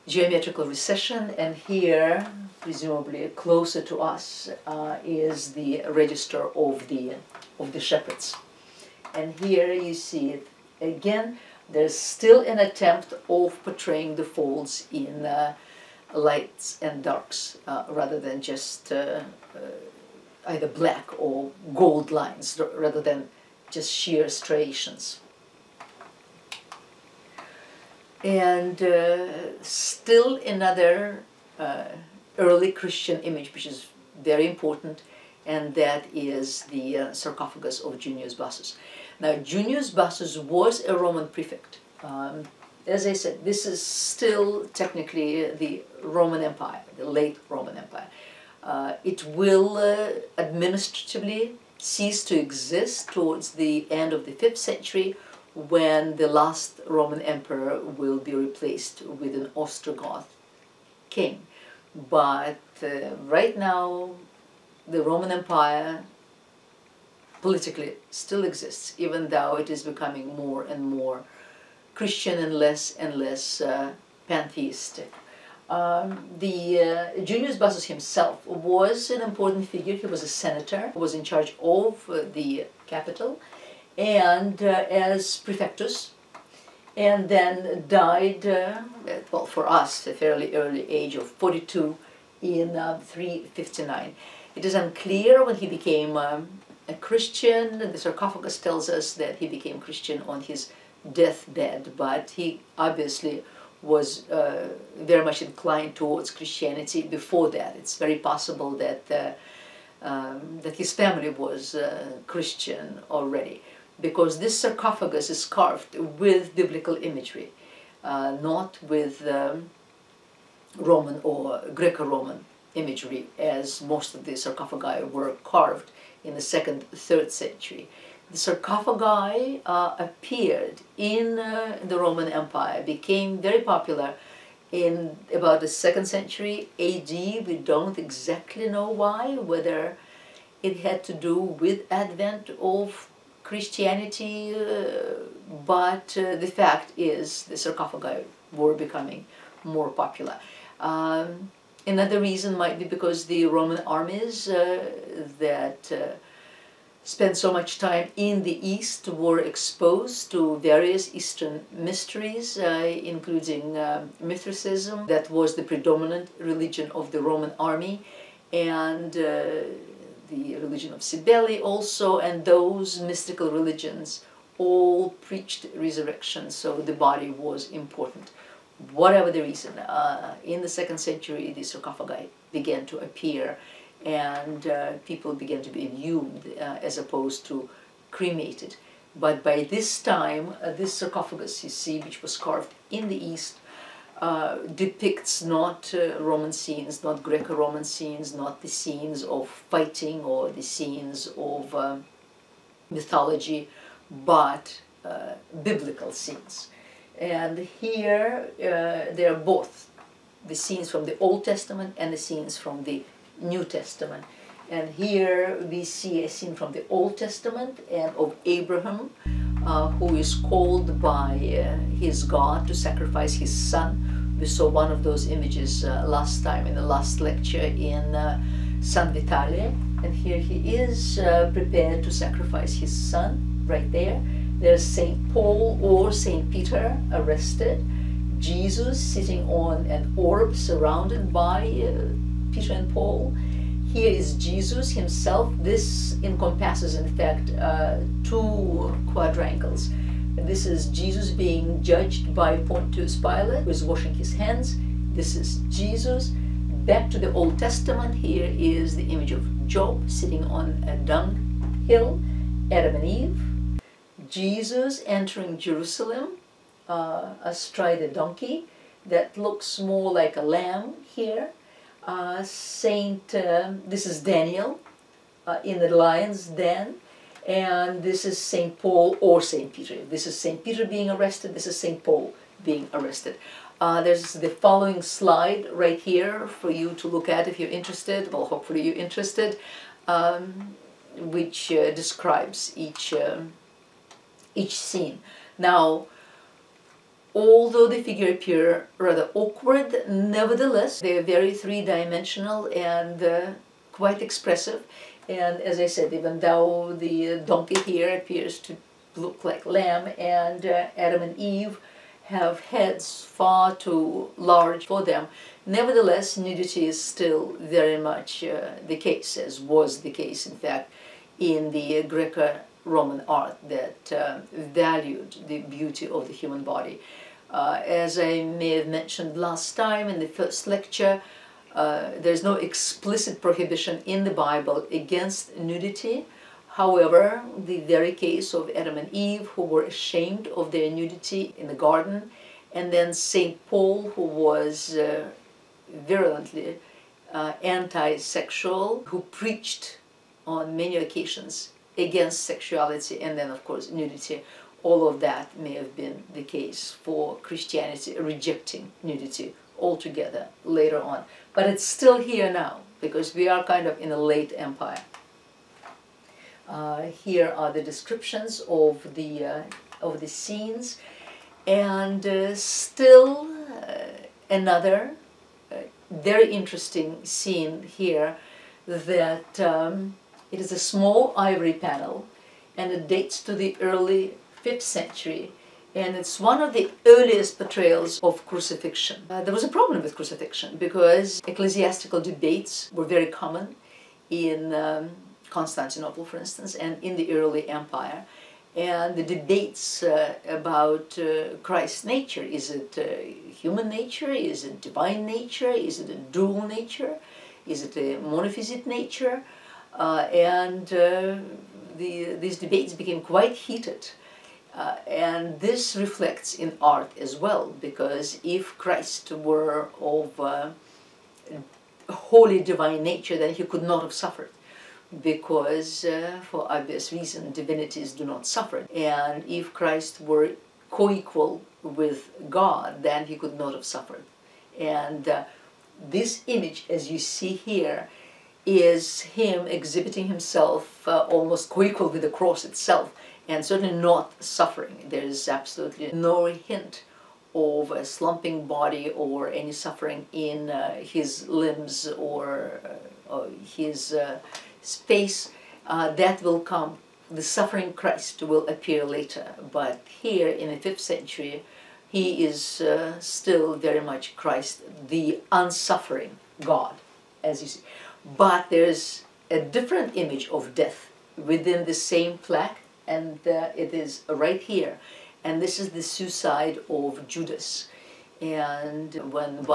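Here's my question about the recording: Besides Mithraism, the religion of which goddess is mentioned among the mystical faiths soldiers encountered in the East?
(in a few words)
Cybele.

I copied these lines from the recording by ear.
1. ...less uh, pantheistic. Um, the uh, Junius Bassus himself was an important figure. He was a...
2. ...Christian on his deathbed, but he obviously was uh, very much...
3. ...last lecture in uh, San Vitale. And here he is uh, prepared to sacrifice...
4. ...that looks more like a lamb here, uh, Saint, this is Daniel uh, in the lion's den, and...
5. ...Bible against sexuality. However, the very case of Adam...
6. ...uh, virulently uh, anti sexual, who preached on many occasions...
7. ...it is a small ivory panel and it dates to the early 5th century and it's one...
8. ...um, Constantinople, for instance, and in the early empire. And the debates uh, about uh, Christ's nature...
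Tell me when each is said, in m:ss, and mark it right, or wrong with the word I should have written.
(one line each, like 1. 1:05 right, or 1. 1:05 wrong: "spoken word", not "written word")
1. 1:13 right
2. 1:39 right
3. 3:46 right
4. 4:29 right
5. 5:34 wrong: "nudity", not "sexuality"
6. 5:44 right
7. 6:20 right
8. 6:34 right.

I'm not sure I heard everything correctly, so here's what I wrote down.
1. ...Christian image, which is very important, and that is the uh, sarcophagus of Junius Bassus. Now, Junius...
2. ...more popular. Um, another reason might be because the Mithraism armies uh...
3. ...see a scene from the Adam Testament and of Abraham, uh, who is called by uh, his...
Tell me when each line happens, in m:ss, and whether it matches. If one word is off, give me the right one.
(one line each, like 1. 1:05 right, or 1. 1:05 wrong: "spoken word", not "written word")
1. 0:32 right
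2. 2:29 wrong: "Roman", not "Mithraism"
3. 3:35 wrong: "Old", not "Adam".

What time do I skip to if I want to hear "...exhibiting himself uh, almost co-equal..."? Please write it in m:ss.
7:19.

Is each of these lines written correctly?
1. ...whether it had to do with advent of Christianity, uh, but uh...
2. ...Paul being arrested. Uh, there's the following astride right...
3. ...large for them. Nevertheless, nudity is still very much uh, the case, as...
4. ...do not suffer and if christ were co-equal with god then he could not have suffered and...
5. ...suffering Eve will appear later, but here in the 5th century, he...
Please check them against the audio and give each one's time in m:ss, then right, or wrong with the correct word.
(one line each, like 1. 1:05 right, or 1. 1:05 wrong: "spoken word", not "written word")
1. 2:19 right
2. 4:42 wrong: "slide", not "astride"
3. 5:14 right
4. 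7:08 right
5. 7:37 wrong: "Christ", not "Eve".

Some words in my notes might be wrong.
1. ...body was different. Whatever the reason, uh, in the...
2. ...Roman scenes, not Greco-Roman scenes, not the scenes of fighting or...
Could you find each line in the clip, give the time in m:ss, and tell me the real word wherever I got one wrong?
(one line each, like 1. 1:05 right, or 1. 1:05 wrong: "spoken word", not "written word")
1. 2:56 wrong: "important", not "different"
2. 3:16 right.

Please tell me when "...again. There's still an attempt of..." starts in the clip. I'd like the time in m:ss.
0:10.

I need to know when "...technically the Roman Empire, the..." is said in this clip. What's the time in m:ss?
0:44.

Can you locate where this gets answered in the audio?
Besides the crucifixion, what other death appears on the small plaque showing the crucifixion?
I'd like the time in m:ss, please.
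7:56.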